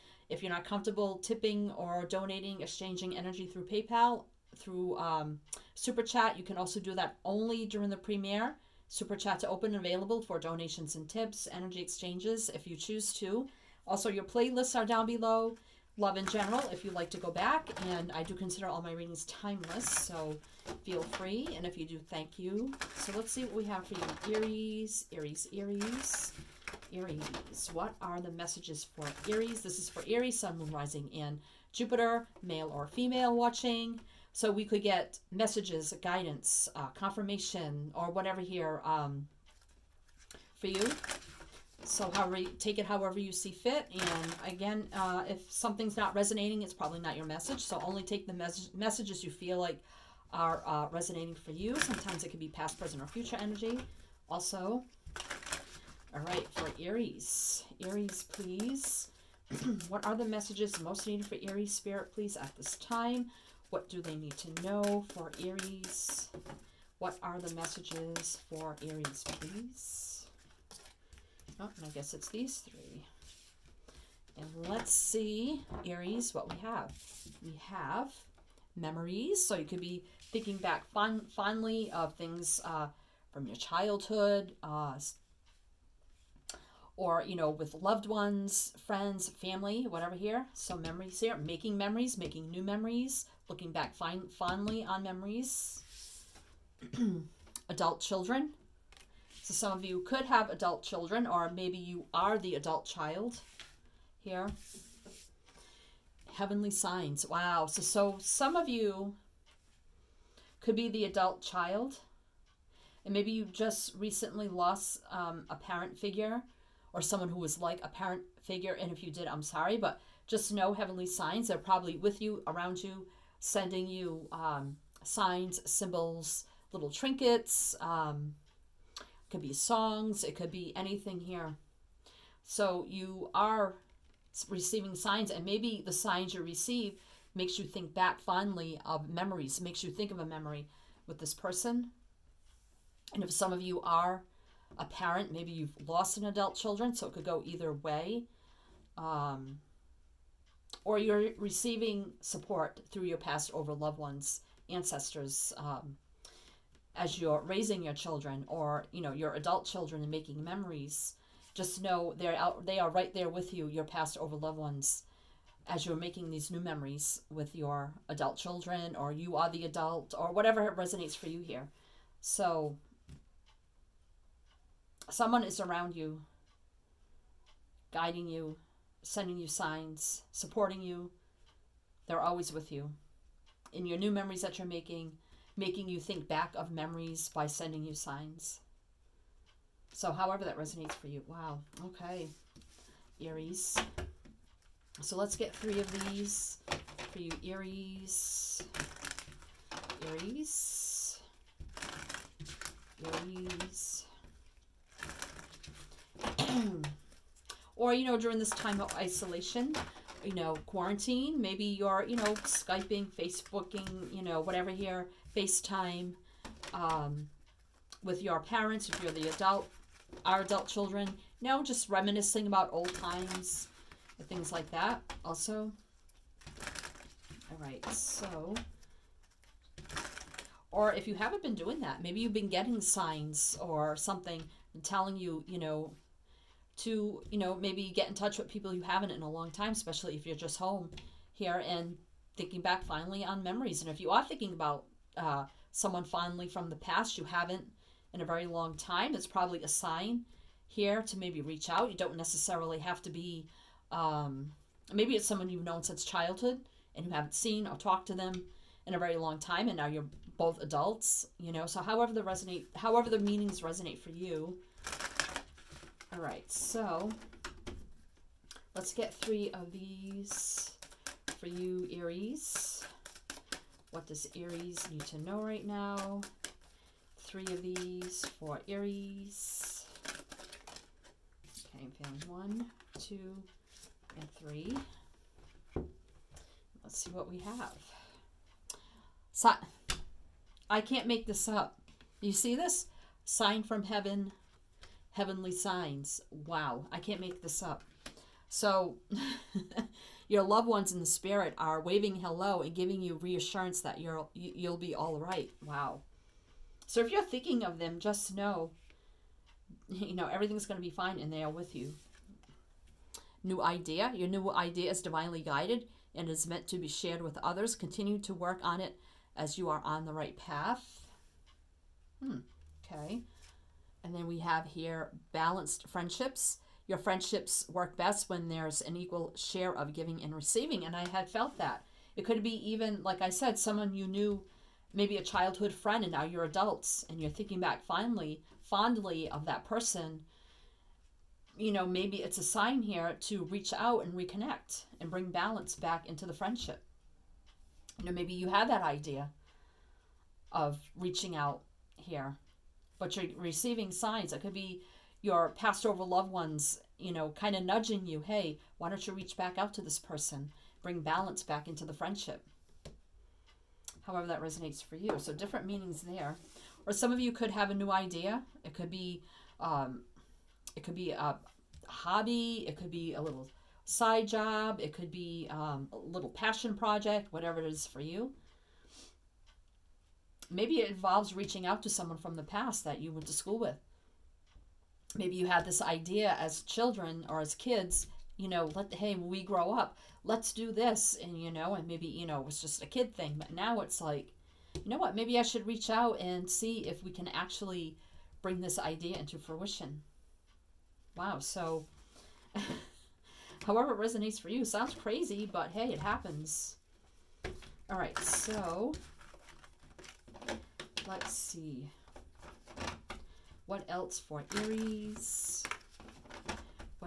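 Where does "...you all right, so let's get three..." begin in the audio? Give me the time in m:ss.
4:24.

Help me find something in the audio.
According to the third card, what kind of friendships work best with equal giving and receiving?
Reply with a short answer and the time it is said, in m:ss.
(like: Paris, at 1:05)
Balanced friendships, at 5:25.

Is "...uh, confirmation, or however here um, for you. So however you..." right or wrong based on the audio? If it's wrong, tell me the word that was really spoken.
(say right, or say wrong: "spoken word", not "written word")
wrong: "whatever", not "however".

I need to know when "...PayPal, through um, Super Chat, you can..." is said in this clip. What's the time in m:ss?
0:03.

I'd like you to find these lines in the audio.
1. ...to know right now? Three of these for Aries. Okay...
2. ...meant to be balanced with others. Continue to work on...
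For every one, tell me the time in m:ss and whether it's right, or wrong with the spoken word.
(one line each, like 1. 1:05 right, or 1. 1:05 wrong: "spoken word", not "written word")
1. 4:35 right
2. 5:16 wrong: "shared", not "balanced".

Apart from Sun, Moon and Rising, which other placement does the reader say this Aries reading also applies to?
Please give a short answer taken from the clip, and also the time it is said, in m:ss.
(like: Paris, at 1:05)
Jupiter, at 0:31.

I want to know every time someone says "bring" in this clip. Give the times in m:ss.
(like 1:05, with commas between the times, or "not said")
5:45, 6:00, 6:38.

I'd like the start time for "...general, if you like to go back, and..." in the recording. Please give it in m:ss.
0:16.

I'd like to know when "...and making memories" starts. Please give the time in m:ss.
2:40.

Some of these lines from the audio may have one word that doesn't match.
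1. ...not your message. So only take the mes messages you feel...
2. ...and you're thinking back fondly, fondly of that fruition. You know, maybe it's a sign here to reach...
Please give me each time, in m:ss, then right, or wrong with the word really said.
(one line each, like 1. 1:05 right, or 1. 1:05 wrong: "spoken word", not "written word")
1. 0:46 right
2. 5:37 wrong: "person", not "fruition".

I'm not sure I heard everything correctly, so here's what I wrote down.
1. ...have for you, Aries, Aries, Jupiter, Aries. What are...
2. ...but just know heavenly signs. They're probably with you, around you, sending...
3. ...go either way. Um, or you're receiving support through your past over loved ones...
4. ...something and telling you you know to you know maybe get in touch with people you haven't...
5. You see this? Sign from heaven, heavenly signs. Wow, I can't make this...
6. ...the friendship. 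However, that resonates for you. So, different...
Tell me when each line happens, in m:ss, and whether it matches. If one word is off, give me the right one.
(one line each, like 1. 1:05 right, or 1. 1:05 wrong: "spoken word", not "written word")
1. 0:23 wrong: "Aries", not "Jupiter"
2. 1:59 right
3. 2:27 right
4. 3:53 right
5. 4:52 right
6. 6:01 right.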